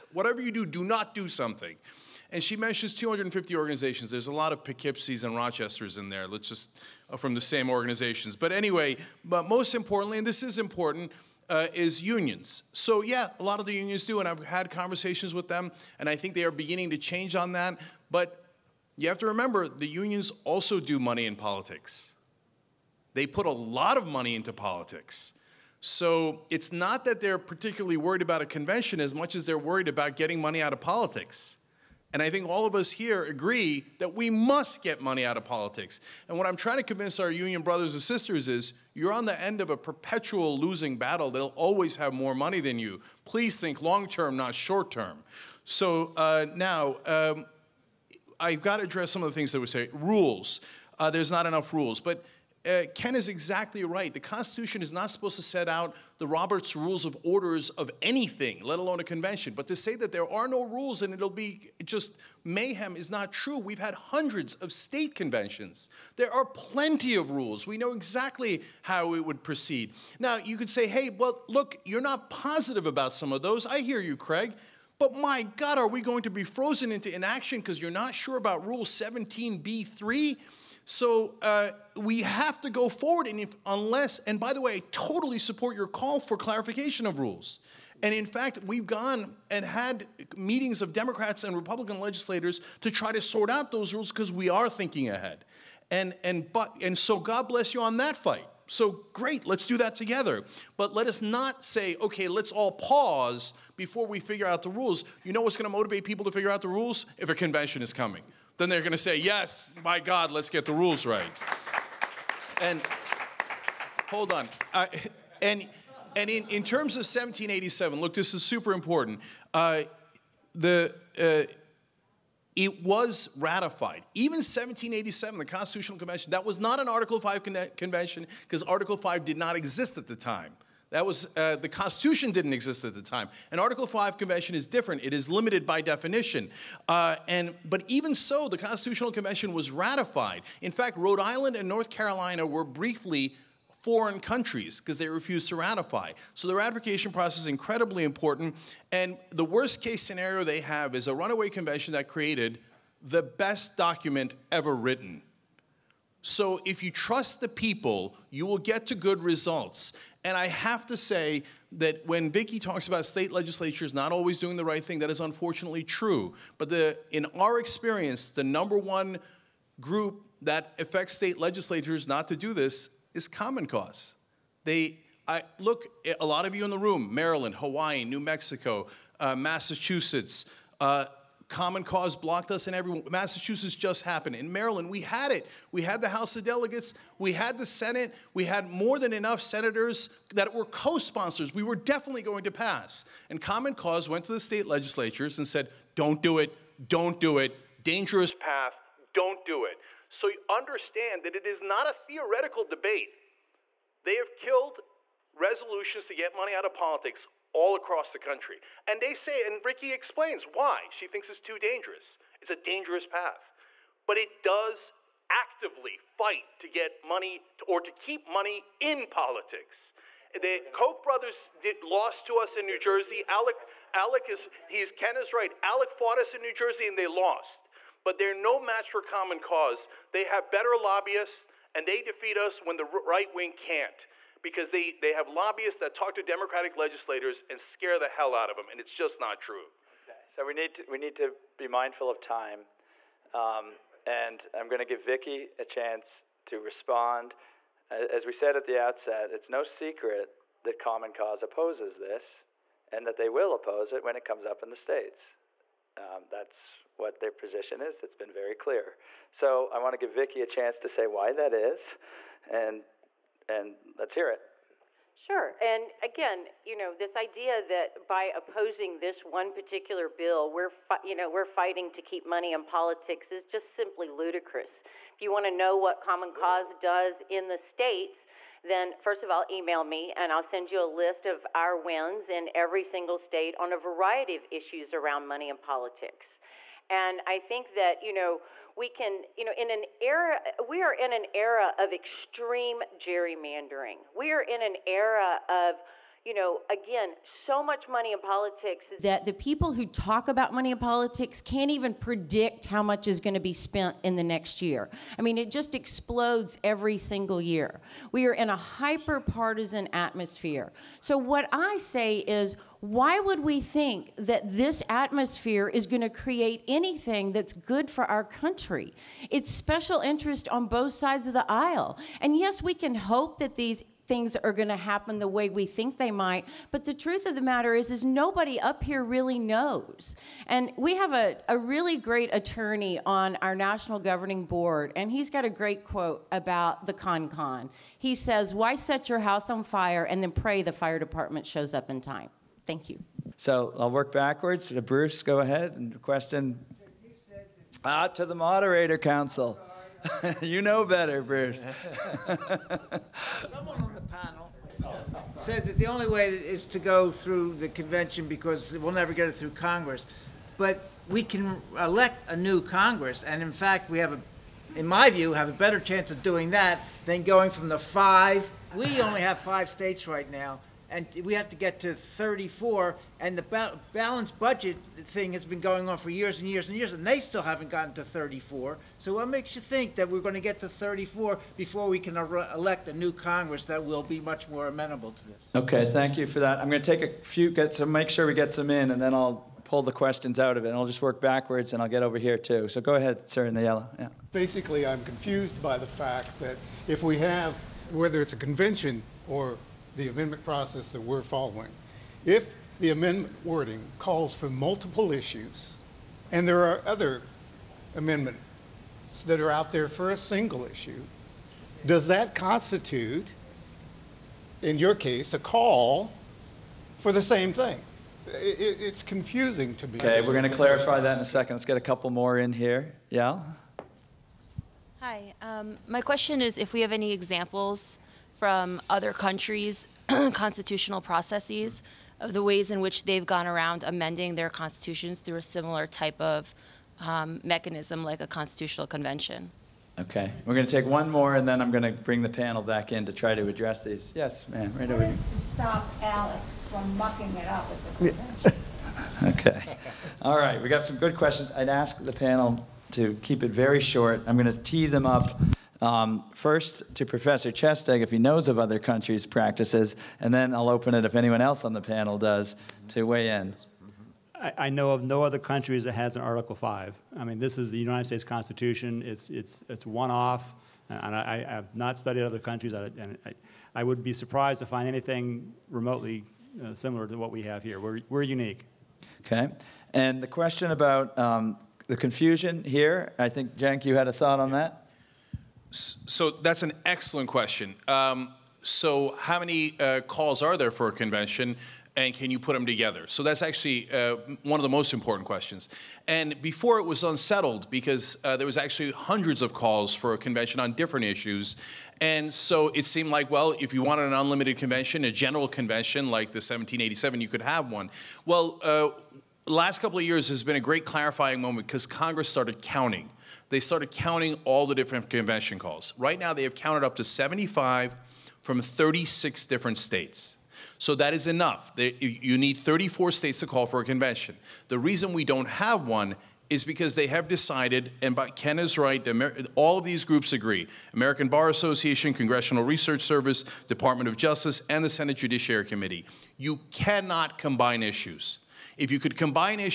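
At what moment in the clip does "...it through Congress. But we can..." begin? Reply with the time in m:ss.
5:59.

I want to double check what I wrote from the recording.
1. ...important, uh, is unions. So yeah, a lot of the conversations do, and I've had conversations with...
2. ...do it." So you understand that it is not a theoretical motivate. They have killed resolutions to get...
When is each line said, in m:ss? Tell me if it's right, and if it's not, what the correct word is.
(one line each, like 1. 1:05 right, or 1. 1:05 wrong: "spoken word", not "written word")
1. 0:10 wrong: "unions", not "conversations"
2. 3:19 wrong: "debate", not "motivate".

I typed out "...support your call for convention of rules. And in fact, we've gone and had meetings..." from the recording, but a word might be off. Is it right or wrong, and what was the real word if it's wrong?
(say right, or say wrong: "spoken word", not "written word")
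wrong: "clarification", not "convention".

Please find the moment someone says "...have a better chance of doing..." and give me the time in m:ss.
6:05.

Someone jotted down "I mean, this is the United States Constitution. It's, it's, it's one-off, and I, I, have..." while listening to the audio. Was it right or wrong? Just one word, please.
right.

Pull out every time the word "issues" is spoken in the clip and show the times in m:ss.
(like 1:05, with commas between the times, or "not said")
4:44, 6:45, 6:50, 8:21, 8:57.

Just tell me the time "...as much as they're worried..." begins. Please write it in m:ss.
0:29.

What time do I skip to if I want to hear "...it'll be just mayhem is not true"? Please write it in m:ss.
1:01.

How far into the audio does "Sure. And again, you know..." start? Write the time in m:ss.
4:25.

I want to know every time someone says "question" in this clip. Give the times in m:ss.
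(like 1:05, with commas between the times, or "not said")
5:46, 6:29, 7:06, 7:31, 8:00, 8:07, 8:15.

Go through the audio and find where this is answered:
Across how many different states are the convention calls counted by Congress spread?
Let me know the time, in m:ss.
8:38.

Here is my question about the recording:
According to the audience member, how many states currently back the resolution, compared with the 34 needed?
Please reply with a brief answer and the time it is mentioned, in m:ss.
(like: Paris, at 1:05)
5, at 6:09.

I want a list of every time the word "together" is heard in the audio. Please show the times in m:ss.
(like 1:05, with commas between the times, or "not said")
1:39, 8:12.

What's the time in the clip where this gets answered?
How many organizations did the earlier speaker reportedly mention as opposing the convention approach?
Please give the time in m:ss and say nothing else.
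0:02.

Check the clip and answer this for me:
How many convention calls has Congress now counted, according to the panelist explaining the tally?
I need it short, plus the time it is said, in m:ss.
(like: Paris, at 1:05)
75, at 8:37.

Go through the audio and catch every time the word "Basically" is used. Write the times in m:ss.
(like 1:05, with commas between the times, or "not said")
6:34.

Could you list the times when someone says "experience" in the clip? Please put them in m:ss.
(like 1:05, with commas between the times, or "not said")
2:47.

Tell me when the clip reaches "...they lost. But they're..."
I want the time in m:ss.
3:46.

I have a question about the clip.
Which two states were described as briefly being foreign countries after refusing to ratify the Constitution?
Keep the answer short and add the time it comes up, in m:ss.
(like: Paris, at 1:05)
Rhode Island and North Carolina, at 2:20.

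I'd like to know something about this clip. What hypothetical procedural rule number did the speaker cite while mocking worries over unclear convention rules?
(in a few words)
Rule 17b3.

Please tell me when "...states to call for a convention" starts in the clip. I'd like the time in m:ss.
8:43.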